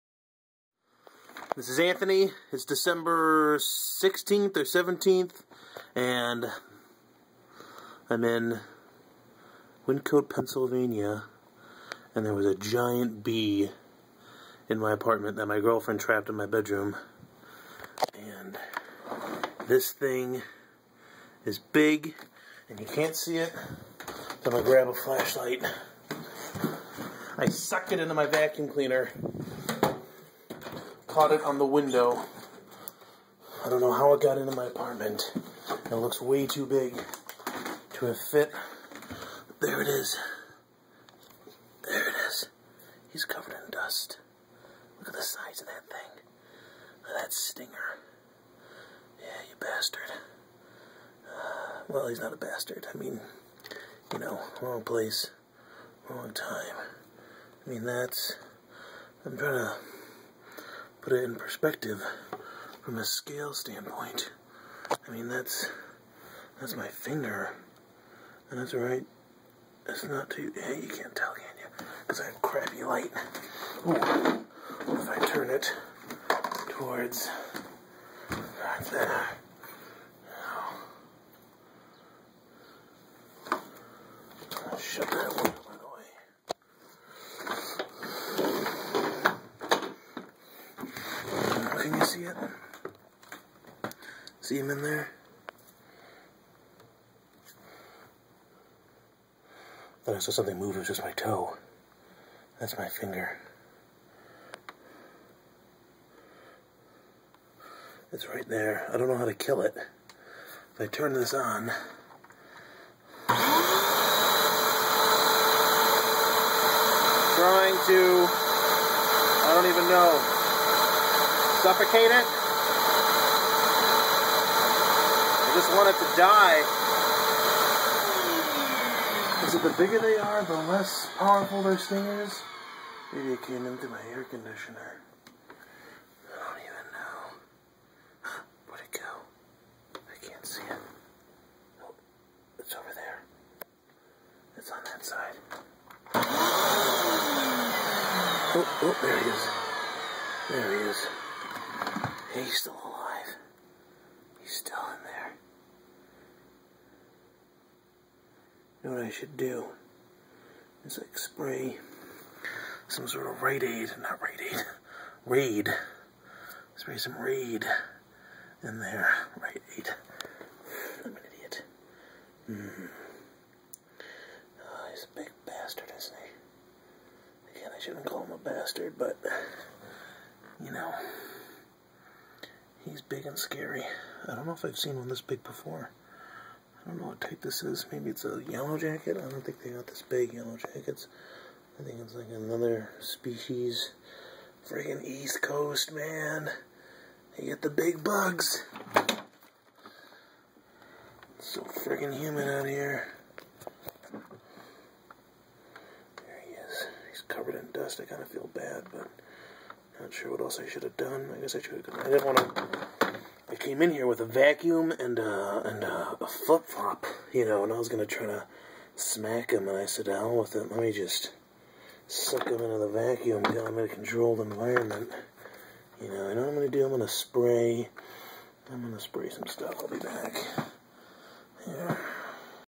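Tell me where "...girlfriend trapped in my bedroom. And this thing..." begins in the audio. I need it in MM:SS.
00:15.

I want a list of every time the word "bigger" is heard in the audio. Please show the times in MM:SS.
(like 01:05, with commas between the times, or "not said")
02:09.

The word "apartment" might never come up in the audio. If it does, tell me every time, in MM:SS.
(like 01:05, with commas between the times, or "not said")
00:14, 00:34.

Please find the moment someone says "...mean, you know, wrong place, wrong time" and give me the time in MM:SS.
00:52.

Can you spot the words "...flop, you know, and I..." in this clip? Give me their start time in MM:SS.
03:36.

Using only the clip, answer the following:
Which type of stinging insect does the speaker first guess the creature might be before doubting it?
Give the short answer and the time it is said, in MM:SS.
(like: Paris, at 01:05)
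yellow jacket, at 03:08.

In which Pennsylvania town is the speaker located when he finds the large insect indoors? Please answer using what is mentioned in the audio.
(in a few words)
Wyncote.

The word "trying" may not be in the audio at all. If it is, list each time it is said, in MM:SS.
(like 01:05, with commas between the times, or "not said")
00:59, 01:57.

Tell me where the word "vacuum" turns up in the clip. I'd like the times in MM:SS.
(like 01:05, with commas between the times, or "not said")
00:28, 03:34, 03:42.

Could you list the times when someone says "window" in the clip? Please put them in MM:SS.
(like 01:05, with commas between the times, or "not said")
00:31.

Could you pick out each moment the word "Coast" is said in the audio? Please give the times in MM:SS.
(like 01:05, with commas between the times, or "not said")
03:15.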